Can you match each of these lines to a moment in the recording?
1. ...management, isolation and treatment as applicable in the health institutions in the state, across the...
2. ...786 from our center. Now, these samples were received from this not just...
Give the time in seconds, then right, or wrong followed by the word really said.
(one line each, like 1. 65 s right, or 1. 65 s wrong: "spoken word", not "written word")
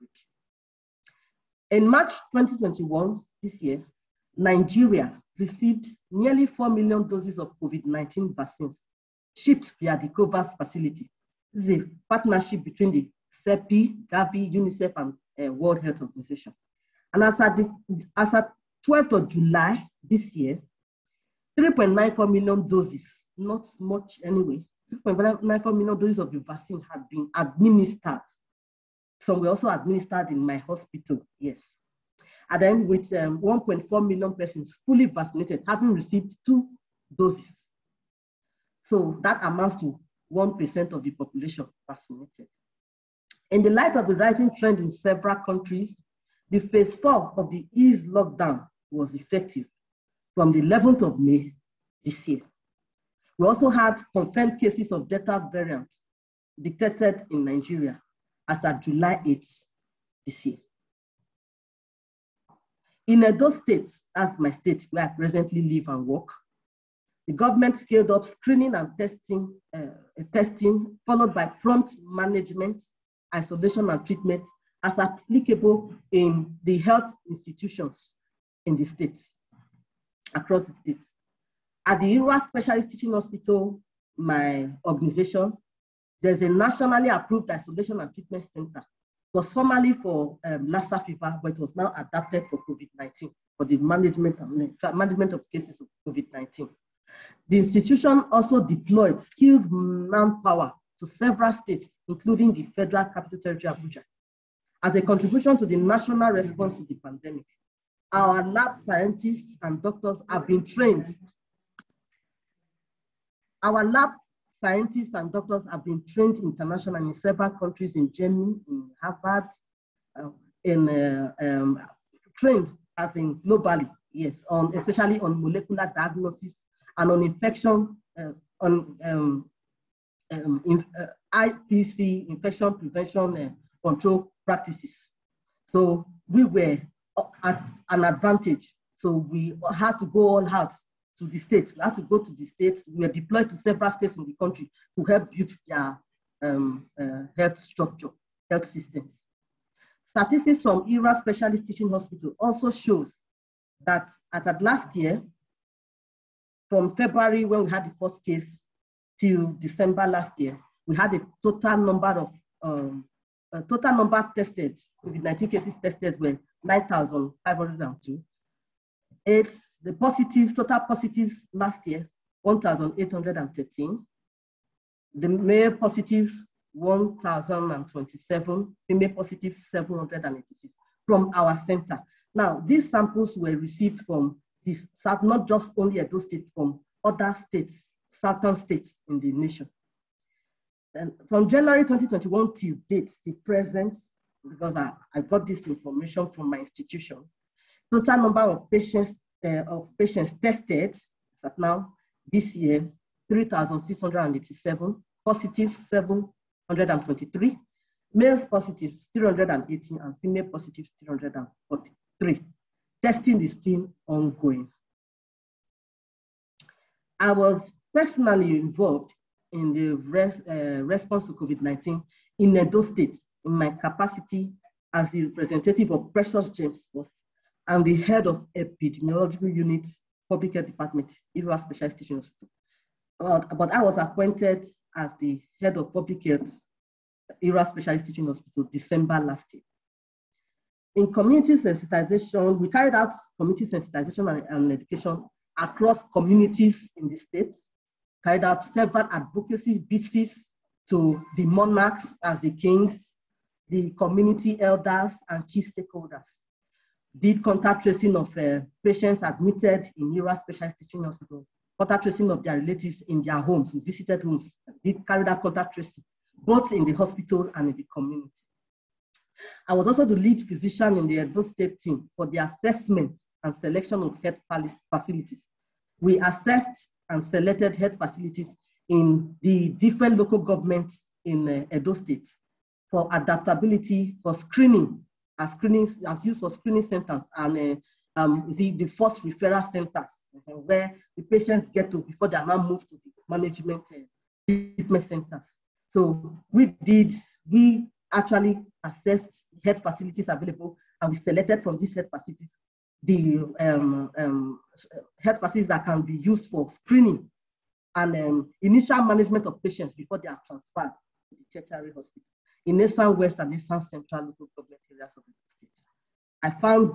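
1. 72 s right
2. 179 s right.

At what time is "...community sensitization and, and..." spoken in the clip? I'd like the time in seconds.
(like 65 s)
243 s.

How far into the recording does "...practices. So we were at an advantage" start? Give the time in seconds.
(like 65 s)
134 s.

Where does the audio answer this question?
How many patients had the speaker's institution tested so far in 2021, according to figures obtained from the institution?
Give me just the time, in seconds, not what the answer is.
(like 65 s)
203 s.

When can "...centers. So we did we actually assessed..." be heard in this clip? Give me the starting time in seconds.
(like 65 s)
295 s.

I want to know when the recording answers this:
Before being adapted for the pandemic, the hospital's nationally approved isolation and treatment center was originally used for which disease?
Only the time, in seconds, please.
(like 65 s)
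90 s.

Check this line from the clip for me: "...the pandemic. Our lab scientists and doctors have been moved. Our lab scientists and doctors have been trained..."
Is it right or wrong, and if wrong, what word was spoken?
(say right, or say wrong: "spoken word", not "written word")
wrong: "trained", not "moved".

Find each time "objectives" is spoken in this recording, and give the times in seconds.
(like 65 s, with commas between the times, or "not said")
not said.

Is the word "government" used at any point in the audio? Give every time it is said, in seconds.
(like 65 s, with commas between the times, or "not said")
67 s, 280 s, 314 s.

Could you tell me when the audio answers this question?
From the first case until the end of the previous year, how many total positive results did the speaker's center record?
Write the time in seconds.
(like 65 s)
172 s.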